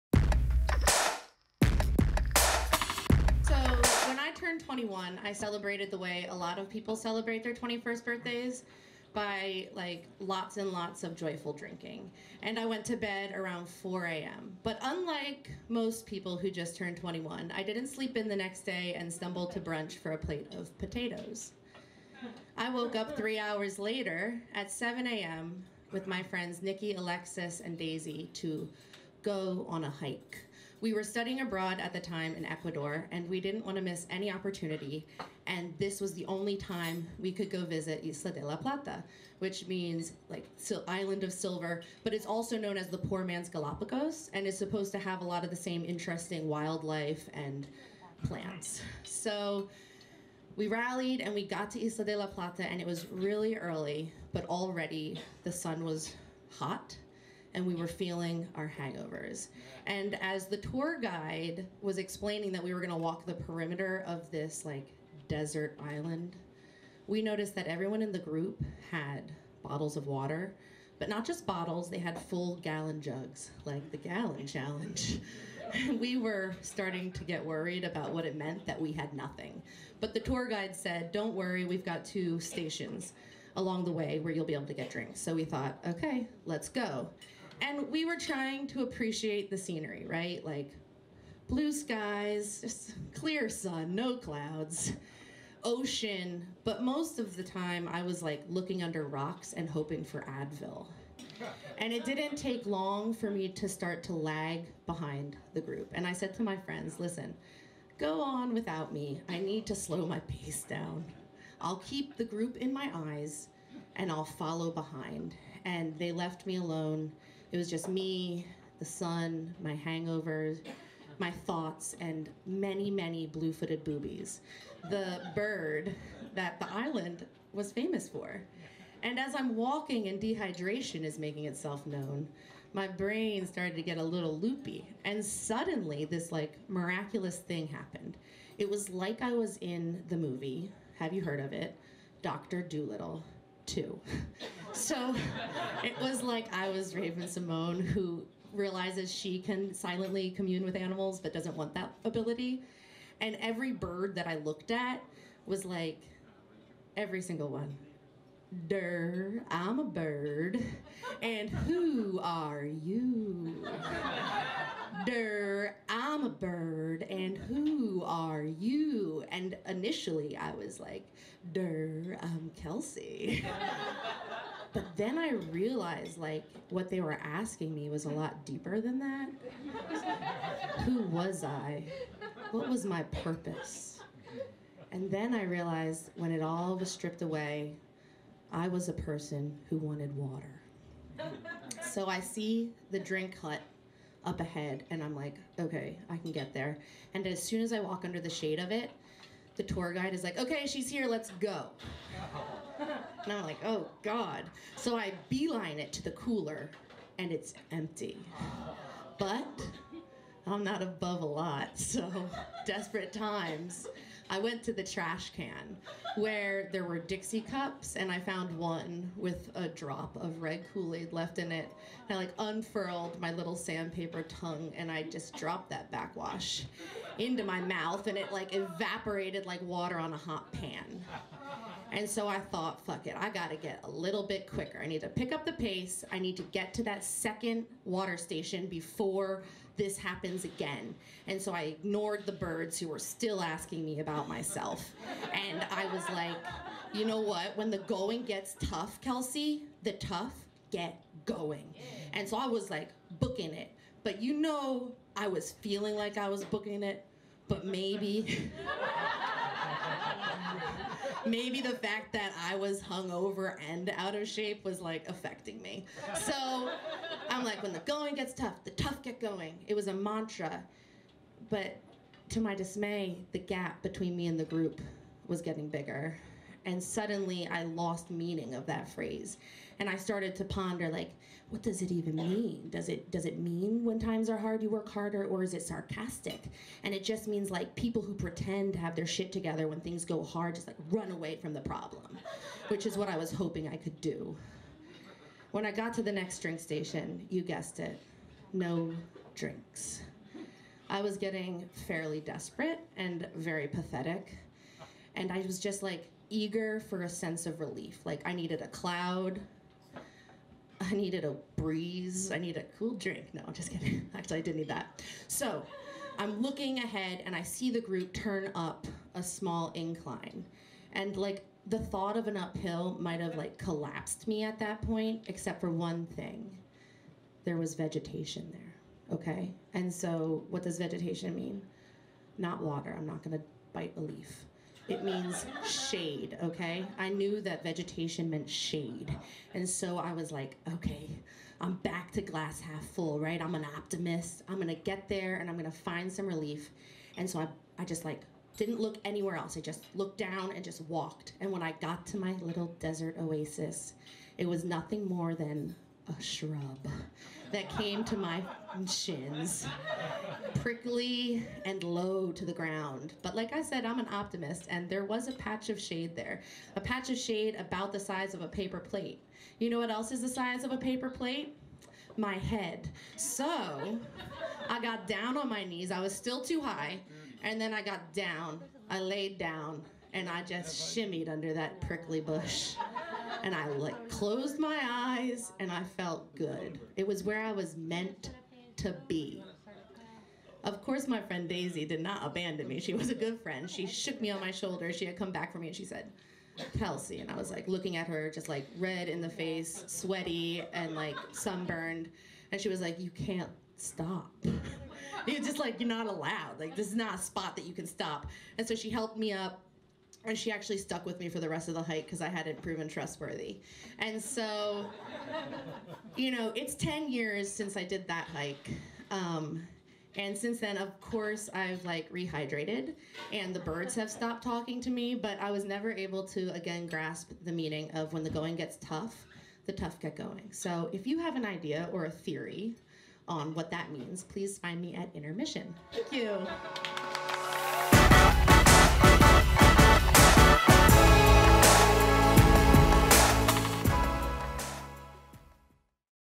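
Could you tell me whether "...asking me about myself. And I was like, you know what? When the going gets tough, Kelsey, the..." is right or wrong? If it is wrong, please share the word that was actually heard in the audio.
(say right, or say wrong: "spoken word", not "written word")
right.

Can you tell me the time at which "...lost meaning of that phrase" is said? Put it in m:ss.
4:37.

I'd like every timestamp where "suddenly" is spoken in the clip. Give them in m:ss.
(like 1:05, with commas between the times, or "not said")
2:15, 4:36.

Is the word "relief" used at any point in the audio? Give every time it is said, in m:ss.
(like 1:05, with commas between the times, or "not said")
5:07, 5:46.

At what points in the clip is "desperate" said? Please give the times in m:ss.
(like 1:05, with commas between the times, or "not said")
3:32, 5:02.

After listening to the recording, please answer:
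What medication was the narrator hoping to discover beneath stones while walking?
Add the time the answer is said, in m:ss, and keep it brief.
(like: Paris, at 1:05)
Advil, at 1:40.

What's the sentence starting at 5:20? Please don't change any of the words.
And like the thought of an uphill might have like collapsed me at that point, except for one thing.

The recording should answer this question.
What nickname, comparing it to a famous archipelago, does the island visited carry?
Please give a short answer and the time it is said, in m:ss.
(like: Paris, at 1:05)
the poor man's Galapagos, at 0:42.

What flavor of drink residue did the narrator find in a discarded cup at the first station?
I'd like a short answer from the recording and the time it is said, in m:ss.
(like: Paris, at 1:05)
red Kool-Aid, at 3:40.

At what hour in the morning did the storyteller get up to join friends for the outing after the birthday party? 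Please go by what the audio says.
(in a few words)
7 a.m.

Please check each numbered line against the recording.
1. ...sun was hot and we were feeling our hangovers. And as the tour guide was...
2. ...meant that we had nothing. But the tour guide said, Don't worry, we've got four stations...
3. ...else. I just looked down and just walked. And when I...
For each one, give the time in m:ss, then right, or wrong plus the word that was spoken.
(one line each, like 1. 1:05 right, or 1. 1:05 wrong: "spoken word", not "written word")
1. 0:55 right
2. 1:18 wrong: "two", not "four"
3. 5:49 right.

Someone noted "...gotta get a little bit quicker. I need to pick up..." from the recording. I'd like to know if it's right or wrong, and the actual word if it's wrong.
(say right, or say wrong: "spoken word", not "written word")
right.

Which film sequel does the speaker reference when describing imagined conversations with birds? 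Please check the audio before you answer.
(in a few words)
Dr. Dolittle 2.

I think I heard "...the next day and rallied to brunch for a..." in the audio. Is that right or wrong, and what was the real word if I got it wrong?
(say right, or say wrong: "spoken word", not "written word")
wrong: "stumbled", not "rallied".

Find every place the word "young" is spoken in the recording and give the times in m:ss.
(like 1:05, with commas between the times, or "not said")
not said.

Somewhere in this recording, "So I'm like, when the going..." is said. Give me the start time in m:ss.
4:26.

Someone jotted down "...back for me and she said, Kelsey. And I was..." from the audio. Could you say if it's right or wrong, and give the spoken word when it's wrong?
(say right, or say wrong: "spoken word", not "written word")
right.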